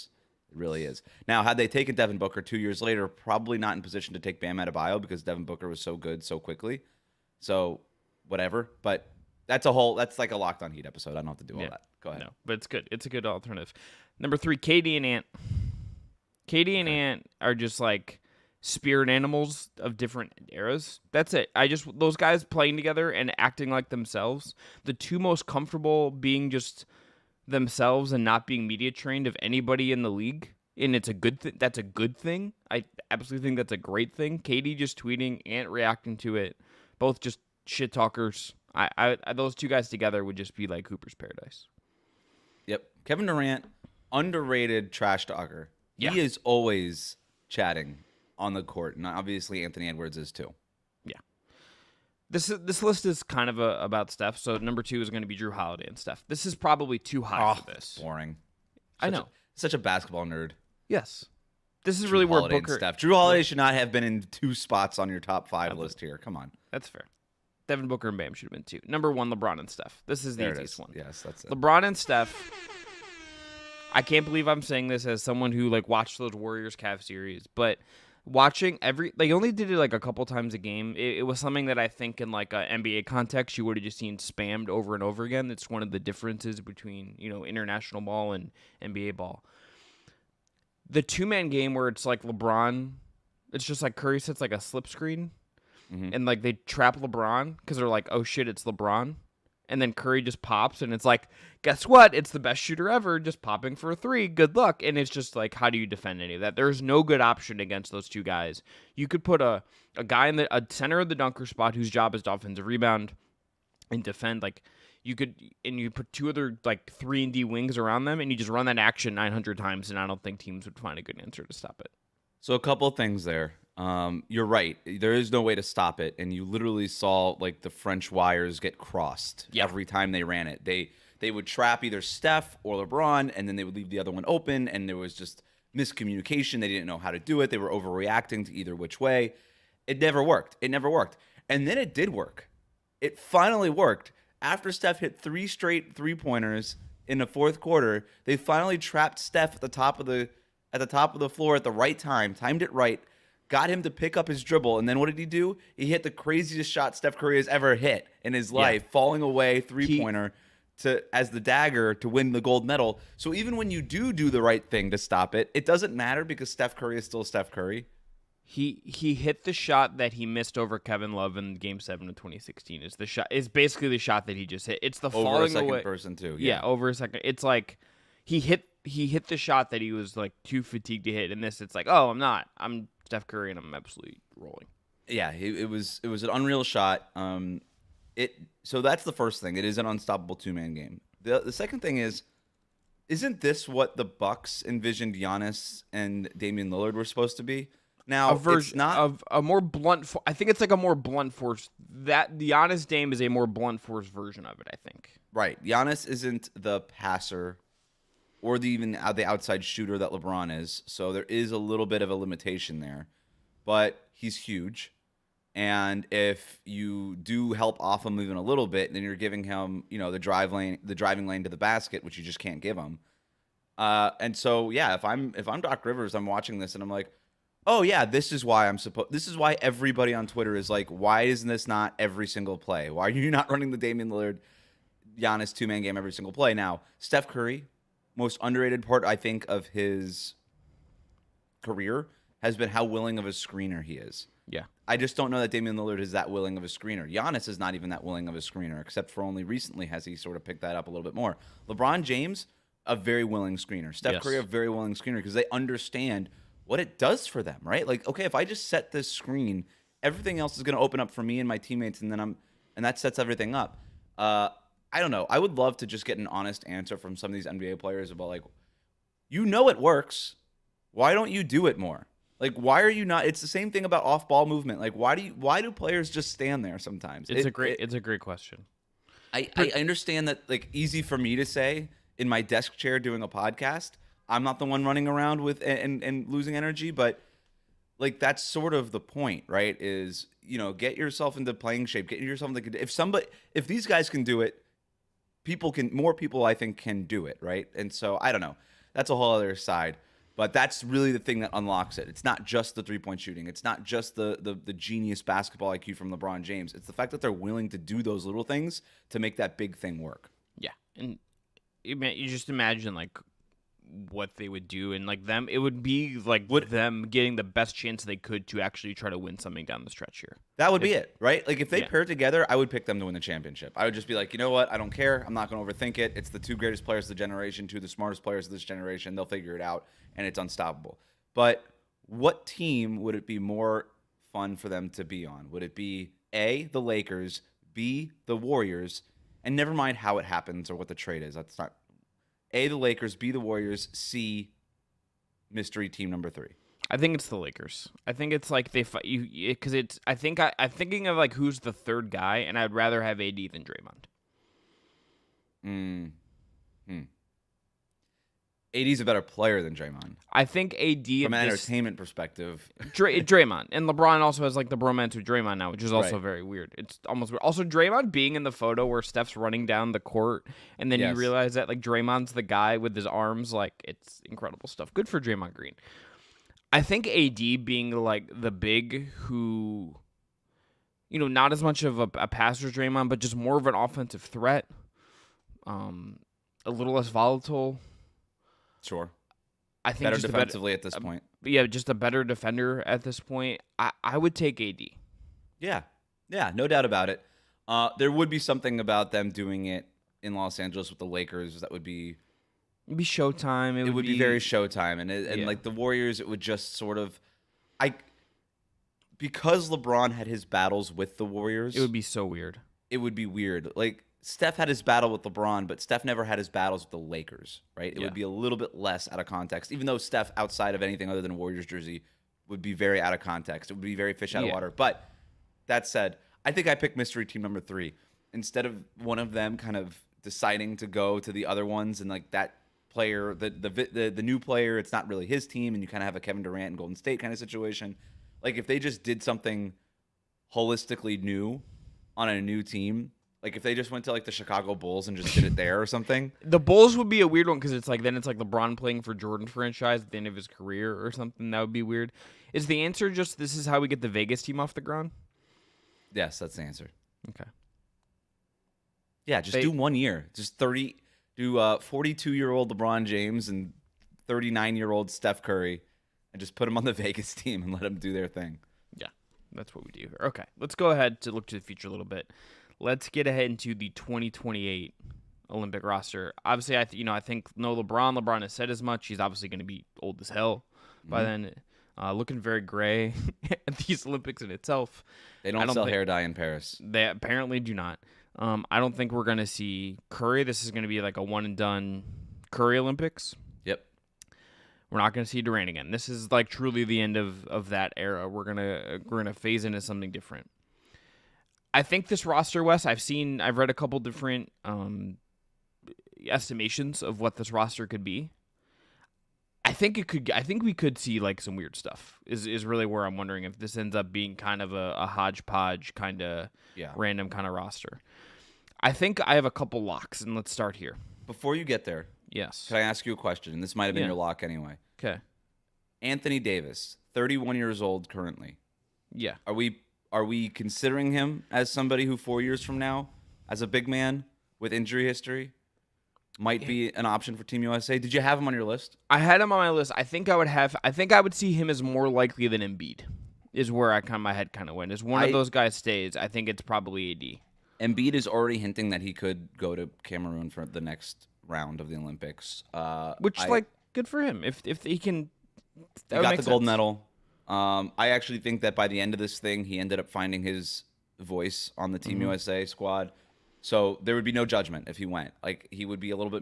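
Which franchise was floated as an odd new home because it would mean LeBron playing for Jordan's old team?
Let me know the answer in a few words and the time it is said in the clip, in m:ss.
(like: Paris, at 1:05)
Chicago Bulls, at 7:24.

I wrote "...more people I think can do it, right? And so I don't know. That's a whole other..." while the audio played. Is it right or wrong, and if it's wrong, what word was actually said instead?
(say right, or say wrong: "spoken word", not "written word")
right.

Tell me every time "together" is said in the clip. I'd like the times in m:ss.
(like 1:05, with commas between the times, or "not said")
0:22, 0:39, 5:22.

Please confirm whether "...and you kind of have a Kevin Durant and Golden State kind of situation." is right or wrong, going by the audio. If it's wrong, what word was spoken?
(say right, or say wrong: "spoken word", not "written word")
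right.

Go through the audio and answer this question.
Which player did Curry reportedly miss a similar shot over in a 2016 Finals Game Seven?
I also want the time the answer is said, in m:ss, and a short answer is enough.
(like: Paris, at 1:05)
Kevin Love, at 2:50.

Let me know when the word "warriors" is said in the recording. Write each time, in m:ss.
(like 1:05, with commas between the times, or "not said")
1:16, 5:38, 5:43, 6:45, 6:51, 7:01.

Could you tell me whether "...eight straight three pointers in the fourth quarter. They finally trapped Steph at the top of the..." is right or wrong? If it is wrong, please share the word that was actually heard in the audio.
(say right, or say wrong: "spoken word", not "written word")
wrong: "three", not "eight".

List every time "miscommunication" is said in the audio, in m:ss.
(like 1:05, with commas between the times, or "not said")
2:15.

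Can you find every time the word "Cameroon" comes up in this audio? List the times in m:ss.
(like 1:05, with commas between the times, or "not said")
9:10.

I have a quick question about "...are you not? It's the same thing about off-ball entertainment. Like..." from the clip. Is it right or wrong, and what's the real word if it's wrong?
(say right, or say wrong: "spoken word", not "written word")
wrong: "movement", not "entertainment".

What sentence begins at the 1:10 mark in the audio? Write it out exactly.
This is the there easiest is.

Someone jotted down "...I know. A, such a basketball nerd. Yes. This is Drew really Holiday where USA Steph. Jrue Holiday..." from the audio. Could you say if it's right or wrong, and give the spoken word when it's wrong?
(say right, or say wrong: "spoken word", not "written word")
wrong: "Booker", not "USA".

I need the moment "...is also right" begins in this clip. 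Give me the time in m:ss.
6:05.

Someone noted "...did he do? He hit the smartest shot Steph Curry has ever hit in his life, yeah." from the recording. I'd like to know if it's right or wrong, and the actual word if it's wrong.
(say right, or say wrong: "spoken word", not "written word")
wrong: "craziest", not "smartest".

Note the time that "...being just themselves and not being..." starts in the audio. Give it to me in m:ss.
0:26.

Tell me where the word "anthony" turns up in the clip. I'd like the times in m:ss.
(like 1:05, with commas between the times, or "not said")
0:49, 8:46.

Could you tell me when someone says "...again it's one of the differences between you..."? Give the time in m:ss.
1:25.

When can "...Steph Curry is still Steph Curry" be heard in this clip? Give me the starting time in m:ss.
2:46.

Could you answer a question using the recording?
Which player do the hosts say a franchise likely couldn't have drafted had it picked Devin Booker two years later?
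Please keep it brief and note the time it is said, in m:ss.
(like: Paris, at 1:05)
Bam Adebayo, at 0:04.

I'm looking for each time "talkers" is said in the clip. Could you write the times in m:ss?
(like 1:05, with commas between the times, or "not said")
0:37, 0:45.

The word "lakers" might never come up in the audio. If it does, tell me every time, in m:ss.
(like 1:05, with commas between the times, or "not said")
5:36, 5:42, 5:47, 6:41, 6:56.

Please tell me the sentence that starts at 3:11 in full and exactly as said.
The the second thing is, isn't this what the Bucks envisioned Giannis and Damian Lillard were supposed to be?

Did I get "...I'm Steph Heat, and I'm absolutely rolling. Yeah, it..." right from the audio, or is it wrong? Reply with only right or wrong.
wrong.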